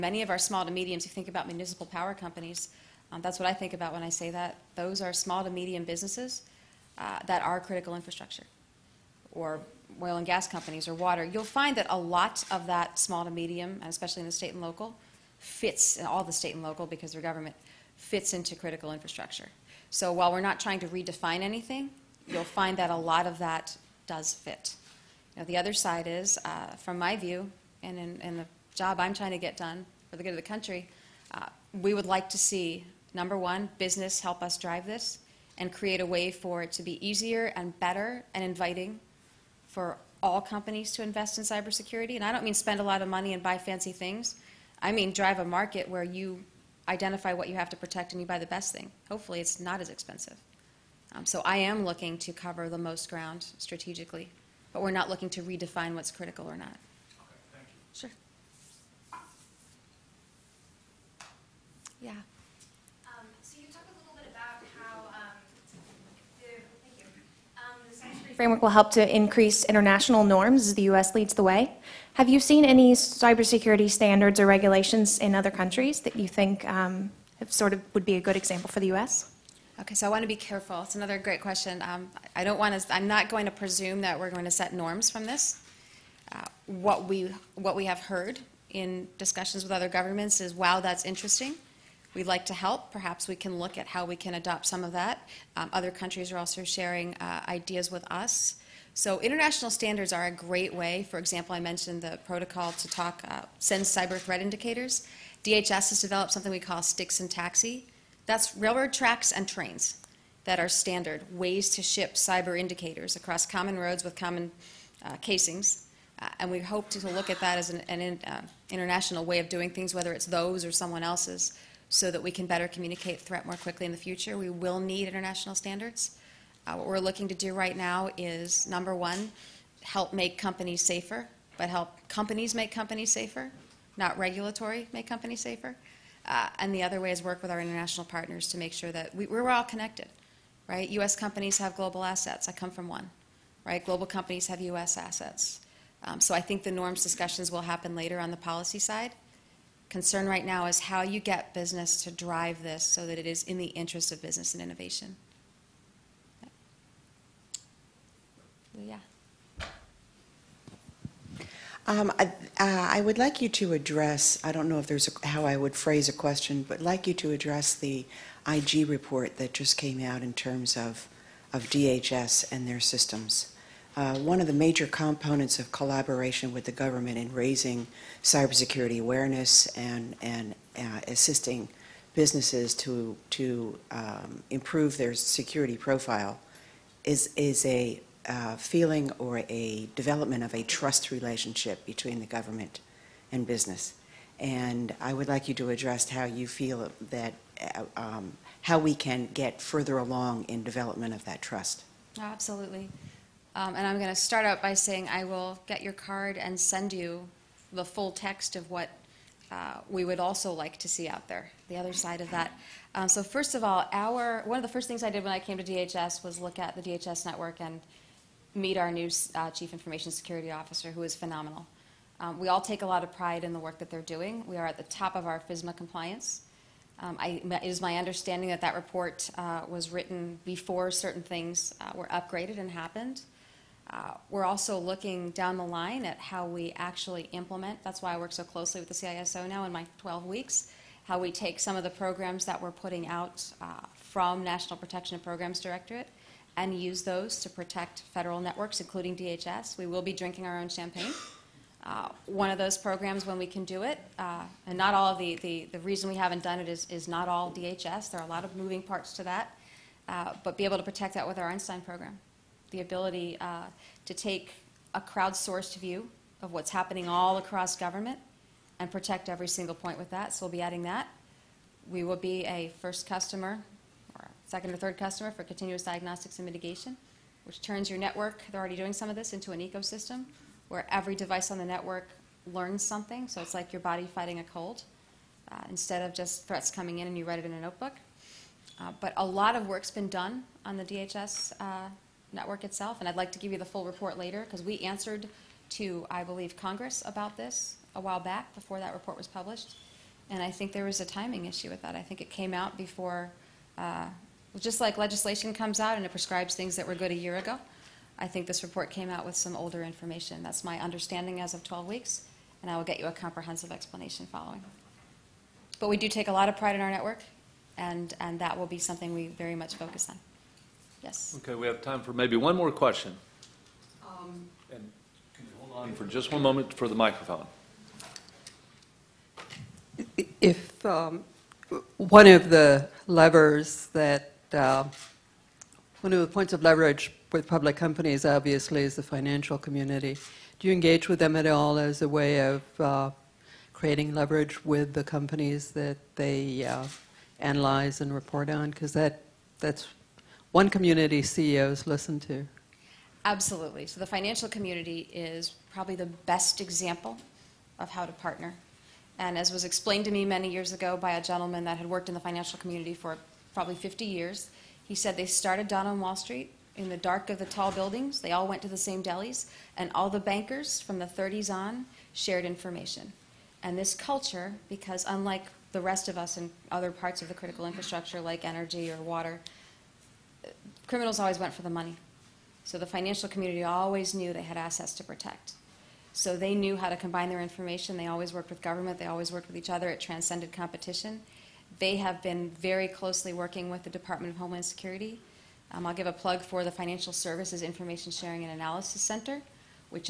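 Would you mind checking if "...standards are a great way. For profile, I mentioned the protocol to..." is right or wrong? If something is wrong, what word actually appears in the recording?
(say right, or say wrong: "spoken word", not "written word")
wrong: "example", not "profile".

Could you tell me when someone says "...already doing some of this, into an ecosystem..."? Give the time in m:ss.
4:38.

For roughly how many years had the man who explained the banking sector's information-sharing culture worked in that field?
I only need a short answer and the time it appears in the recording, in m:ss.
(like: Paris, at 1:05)
50, at 6:03.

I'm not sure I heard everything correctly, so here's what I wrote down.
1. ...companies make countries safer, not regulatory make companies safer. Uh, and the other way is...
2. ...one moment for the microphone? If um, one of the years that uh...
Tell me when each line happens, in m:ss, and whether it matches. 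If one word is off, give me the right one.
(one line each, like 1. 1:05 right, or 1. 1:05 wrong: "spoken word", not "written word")
1. 2:12 wrong: "companies", not "countries"
2. 5:26 wrong: "levers", not "years".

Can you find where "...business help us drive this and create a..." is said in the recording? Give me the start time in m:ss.
0:33.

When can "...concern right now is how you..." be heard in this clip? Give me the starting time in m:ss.
2:29.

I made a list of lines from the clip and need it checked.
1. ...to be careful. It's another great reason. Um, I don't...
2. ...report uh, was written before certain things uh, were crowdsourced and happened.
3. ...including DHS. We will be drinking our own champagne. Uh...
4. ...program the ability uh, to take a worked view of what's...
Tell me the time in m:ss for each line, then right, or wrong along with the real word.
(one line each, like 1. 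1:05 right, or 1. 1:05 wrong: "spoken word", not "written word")
1. 1:20 wrong: "question", not "reason"
2. 3:48 wrong: "upgraded", not "crowdsourced"
3. 4:08 right
4. 4:21 wrong: "crowdsourced", not "worked".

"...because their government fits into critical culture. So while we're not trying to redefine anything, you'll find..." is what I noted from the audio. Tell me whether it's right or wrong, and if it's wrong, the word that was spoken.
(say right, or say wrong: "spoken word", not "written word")
wrong: "infrastructure", not "culture".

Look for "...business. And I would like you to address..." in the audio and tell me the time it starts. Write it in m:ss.
3:13.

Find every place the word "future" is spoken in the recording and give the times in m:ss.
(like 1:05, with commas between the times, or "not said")
2:03.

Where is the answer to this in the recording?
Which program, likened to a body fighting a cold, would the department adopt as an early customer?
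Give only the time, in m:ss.
4:35.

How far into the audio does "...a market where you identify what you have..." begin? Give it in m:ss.
0:45.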